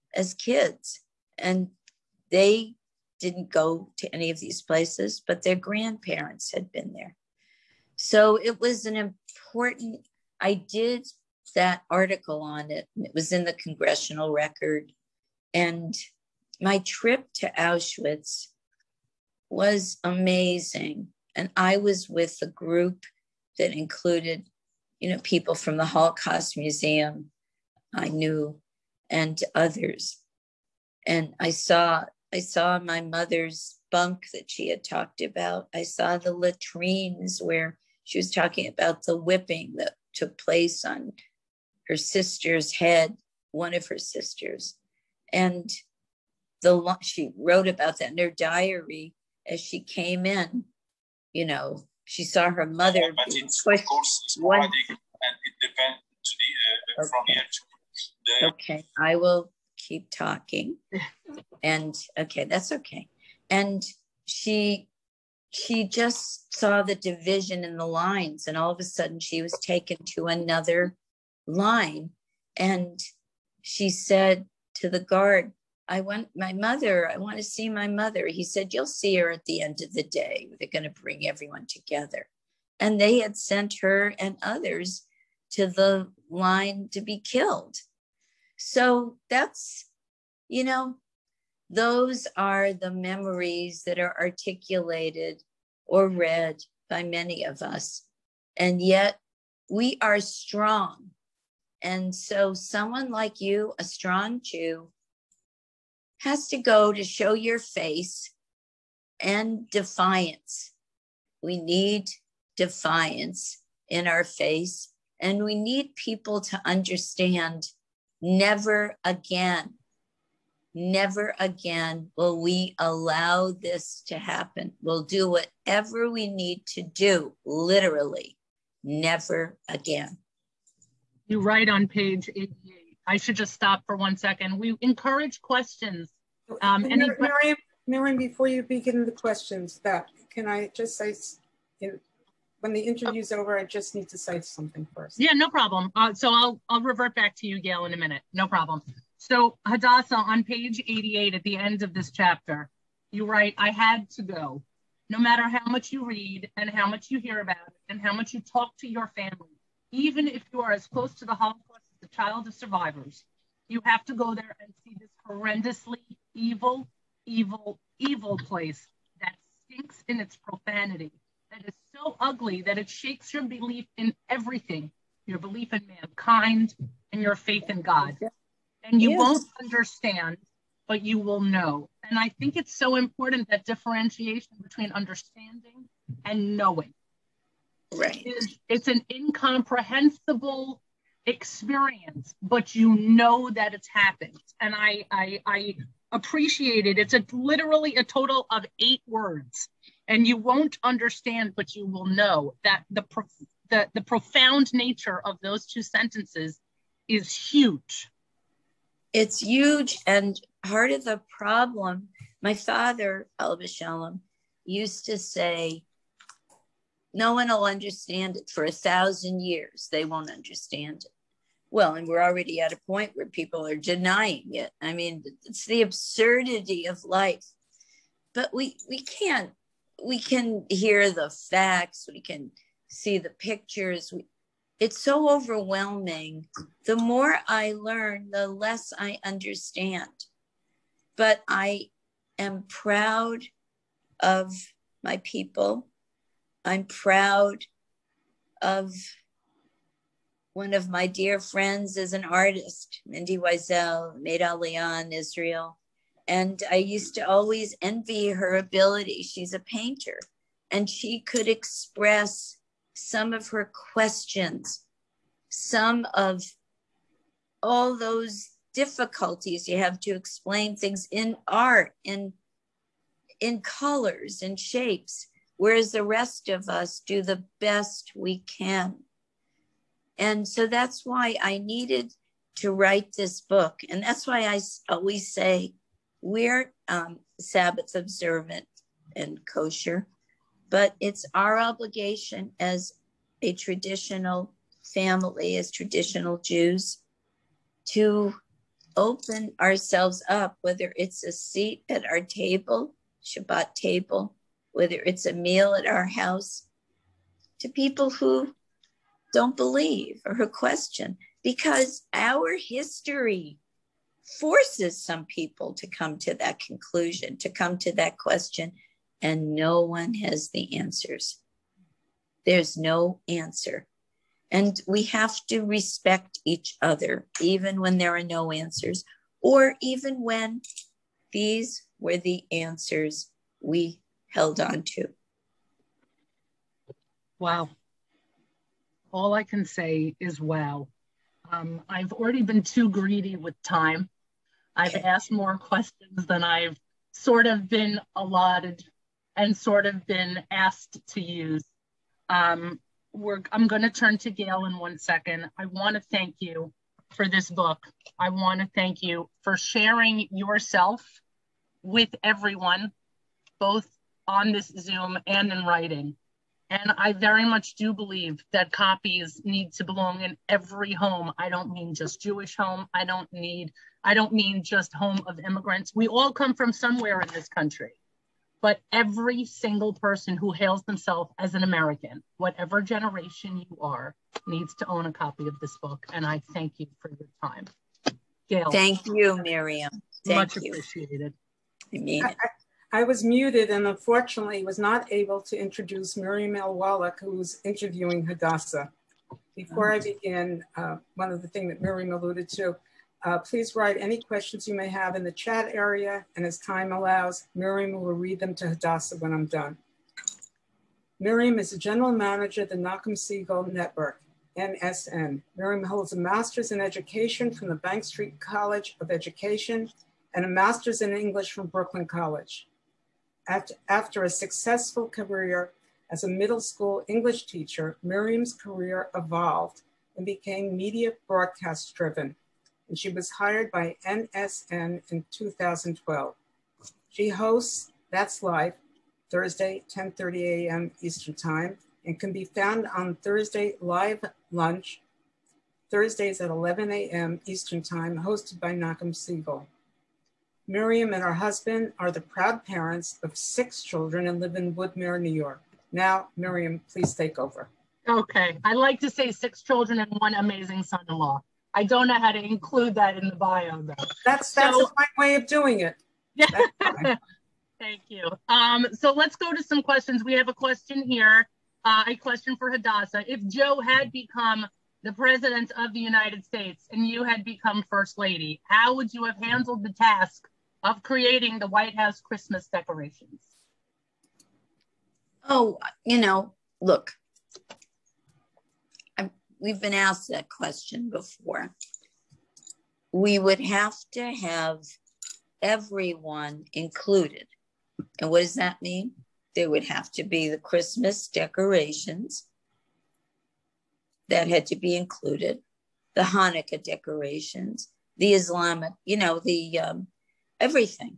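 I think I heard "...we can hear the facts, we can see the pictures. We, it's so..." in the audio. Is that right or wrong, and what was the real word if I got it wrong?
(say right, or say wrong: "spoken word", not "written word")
right.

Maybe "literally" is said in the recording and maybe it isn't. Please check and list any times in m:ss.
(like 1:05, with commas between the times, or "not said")
2:07, 3:17.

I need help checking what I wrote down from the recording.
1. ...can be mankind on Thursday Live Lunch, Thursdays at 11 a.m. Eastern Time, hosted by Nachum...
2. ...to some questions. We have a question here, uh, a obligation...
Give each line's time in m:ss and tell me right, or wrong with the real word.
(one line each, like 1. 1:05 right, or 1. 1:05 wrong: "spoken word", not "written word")
1. 7:22 wrong: "found", not "mankind"
2. 7:49 wrong: "question", not "obligation".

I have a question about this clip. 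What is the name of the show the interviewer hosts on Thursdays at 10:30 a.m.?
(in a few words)
That's Life.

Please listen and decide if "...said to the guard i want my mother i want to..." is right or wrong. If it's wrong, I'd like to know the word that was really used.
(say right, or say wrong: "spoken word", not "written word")
right.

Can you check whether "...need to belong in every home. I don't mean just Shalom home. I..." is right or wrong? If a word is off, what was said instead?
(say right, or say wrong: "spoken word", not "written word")
wrong: "Jewish", not "Shalom".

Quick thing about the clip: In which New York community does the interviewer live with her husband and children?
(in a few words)
Woodmere.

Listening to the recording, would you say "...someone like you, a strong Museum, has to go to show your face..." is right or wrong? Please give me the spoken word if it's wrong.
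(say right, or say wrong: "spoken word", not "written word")
wrong: "Jew", not "Museum".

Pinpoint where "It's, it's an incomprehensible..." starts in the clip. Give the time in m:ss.
3:08.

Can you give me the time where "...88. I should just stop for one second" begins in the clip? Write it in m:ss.
2:12.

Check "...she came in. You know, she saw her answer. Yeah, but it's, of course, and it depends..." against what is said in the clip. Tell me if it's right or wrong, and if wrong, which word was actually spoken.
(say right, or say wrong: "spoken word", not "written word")
wrong: "mother", not "answer".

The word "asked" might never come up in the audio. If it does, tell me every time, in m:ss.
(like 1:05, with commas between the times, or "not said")
5:44, 5:50, 8:09.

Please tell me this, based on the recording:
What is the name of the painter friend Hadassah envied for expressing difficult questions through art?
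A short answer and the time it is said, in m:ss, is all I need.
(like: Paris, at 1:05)
Mindy Weisel, at 4:13.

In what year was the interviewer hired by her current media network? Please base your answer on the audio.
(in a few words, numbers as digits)
2012.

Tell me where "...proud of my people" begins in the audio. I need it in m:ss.
4:02.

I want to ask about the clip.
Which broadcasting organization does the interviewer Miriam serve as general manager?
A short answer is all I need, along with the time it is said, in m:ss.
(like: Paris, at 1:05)
Nachum Segal Network, at 6:52.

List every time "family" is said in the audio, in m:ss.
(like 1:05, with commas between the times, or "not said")
2:39, 4:54.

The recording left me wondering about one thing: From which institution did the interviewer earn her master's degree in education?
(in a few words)
Bank Street College of Education.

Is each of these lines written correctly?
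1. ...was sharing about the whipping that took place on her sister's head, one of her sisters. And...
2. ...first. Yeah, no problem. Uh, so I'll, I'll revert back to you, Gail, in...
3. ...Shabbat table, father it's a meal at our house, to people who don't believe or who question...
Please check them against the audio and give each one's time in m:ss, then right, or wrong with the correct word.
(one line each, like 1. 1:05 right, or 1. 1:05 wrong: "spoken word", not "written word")
1. 0:38 wrong: "talking", not "sharing"
2. 2:24 right
3. 5:03 wrong: "whether", not "father".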